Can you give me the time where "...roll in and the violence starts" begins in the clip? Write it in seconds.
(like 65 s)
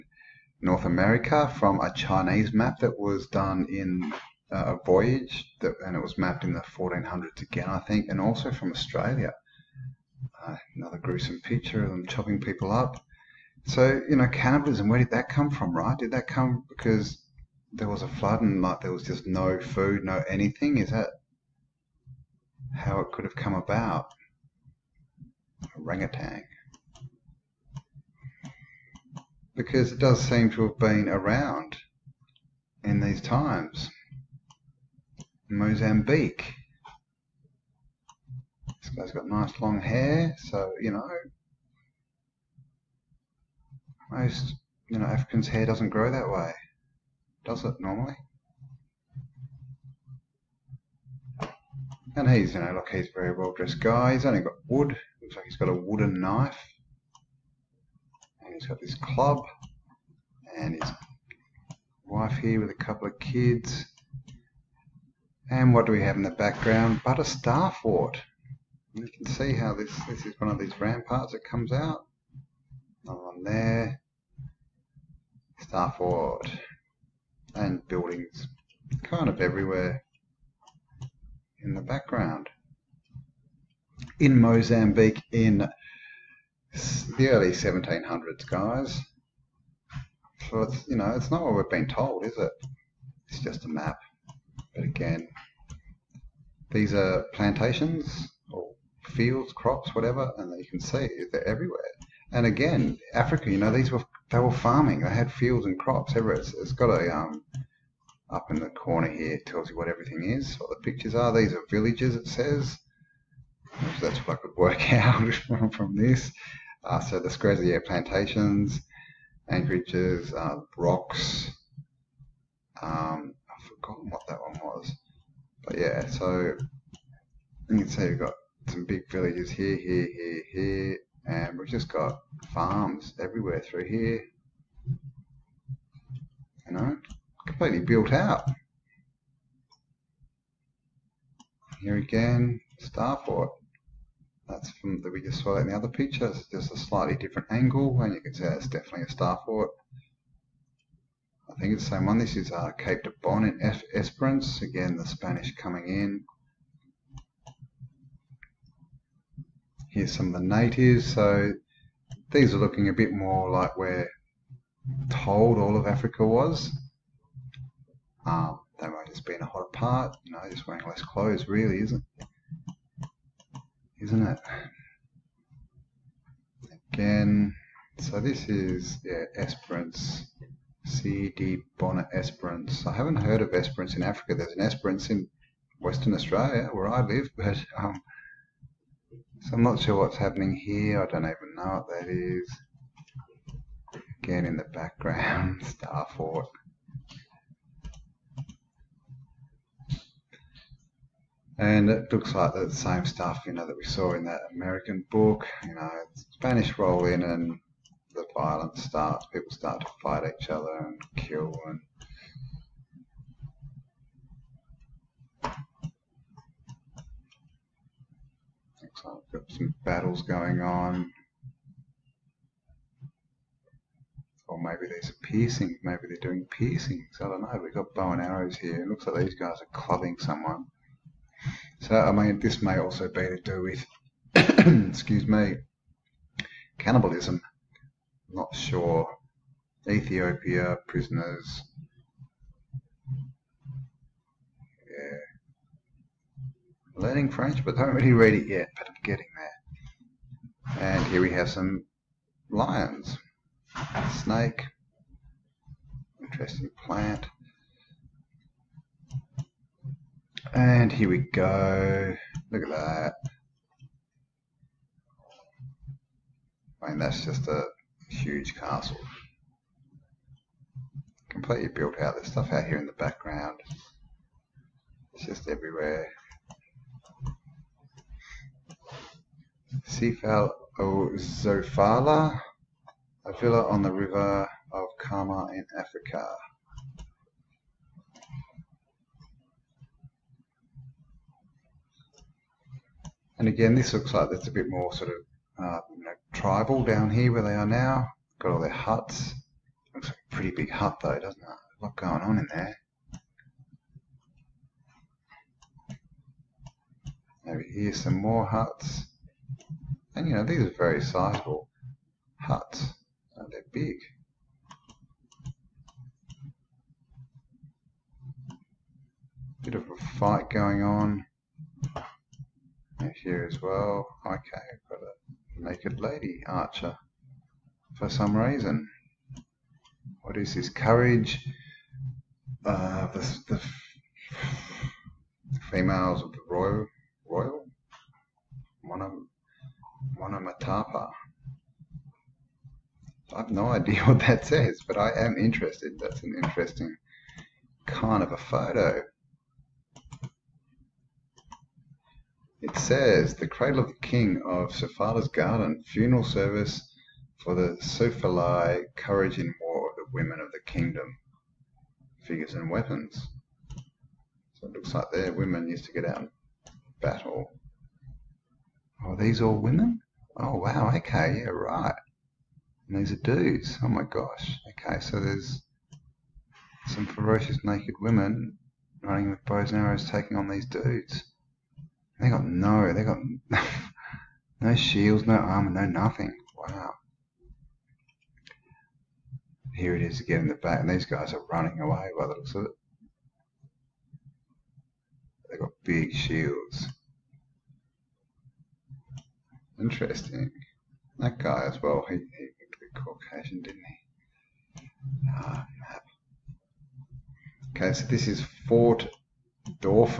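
206 s.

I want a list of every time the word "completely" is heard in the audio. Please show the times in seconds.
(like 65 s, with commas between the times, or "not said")
137 s, 271 s.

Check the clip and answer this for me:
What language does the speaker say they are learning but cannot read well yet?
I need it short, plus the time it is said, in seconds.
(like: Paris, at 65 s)
French, at 247 s.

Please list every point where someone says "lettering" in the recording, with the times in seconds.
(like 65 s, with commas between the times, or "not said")
not said.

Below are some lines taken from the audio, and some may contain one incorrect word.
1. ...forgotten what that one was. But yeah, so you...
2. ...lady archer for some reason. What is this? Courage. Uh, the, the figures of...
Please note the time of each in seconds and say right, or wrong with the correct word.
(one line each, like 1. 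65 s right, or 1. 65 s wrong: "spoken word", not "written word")
1. 123 s right
2. 325 s wrong: "females", not "figures".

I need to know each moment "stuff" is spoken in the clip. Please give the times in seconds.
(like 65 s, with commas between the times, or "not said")
203 s, 272 s.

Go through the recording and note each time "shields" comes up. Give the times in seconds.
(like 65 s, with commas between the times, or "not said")
384 s, 396 s.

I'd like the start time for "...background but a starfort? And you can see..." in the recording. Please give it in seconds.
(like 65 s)
66 s.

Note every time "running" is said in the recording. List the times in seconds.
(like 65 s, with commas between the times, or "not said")
379 s, 391 s.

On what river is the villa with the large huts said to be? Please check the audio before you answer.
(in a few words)
Kama.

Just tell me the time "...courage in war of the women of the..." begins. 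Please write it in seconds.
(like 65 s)
358 s.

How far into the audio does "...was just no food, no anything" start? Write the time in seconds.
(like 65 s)
18 s.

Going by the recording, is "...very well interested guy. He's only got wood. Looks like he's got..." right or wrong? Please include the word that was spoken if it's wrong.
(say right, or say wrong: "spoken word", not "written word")
wrong: "dressed", not "interested".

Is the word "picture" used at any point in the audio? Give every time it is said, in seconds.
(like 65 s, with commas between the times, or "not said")
11 s, 110 s, 145 s.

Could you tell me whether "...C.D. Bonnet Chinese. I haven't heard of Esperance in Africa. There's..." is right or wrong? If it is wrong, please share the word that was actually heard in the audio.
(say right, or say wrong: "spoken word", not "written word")
wrong: "Esperance", not "Chinese".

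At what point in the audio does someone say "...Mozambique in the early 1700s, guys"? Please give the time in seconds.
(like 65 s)
84 s.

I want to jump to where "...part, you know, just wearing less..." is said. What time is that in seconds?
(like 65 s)
169 s.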